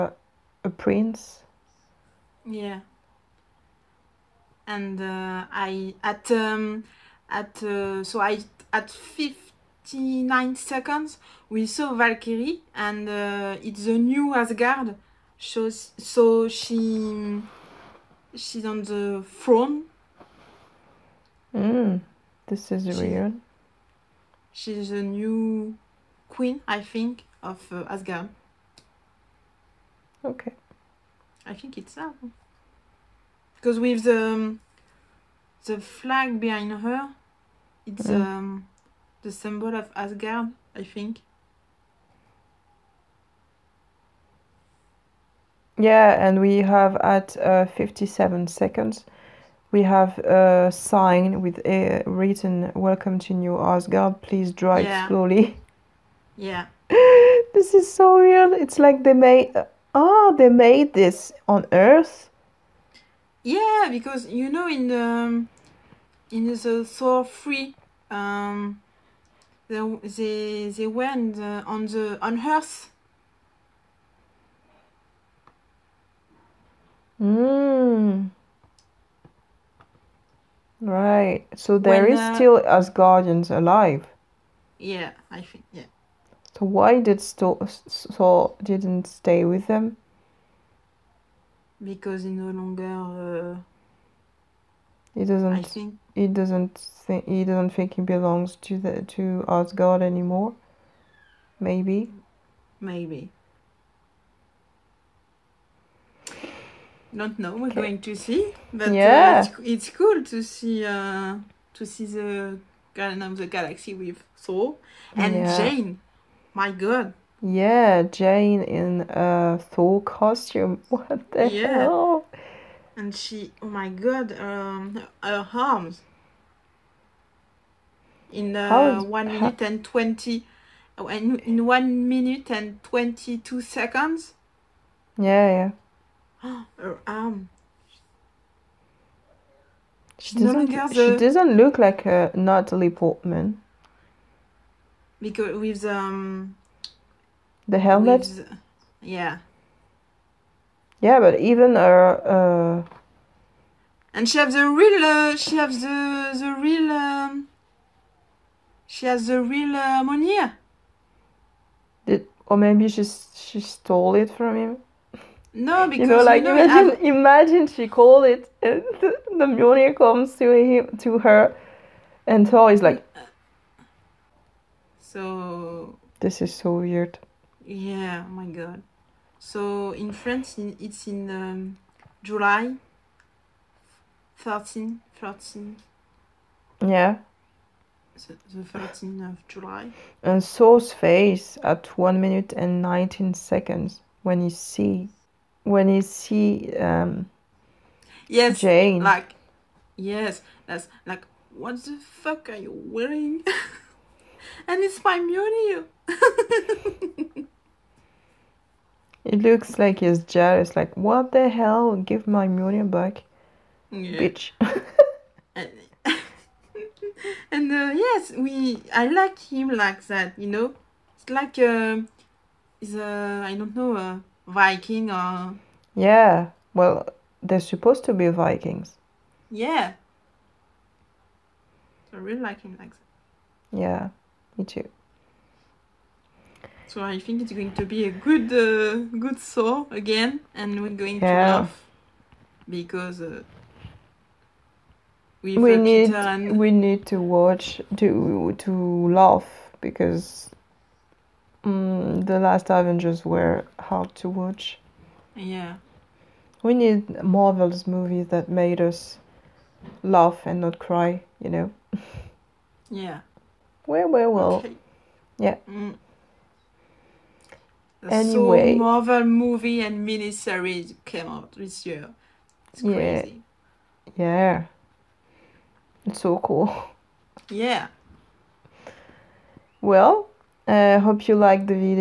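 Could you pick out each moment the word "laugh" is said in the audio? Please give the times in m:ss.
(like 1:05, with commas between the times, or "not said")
4:01, 4:09, 4:20.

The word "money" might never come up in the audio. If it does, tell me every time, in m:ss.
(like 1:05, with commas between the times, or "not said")
2:40, 3:32.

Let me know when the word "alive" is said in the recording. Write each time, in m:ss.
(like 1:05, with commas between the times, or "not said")
1:23.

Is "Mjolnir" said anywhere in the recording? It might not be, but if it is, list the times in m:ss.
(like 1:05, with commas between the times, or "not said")
2:49, 3:25.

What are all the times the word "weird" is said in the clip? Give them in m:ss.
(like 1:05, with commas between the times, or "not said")
0:22, 2:56.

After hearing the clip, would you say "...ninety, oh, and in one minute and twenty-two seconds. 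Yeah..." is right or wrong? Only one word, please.
wrong.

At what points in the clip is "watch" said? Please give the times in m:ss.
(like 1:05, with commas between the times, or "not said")
4:07, 4:14.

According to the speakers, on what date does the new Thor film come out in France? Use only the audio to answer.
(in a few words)
13th of July.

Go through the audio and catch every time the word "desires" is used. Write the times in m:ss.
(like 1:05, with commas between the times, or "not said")
not said.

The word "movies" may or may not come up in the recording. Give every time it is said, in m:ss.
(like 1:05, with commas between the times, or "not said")
4:17, 4:29.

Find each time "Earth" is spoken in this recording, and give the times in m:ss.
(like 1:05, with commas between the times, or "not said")
1:01, 1:12.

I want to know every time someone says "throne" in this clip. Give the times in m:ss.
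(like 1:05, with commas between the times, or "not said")
0:19.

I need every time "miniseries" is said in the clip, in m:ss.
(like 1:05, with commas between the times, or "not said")
4:30.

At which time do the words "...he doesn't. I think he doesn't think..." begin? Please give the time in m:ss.
1:35.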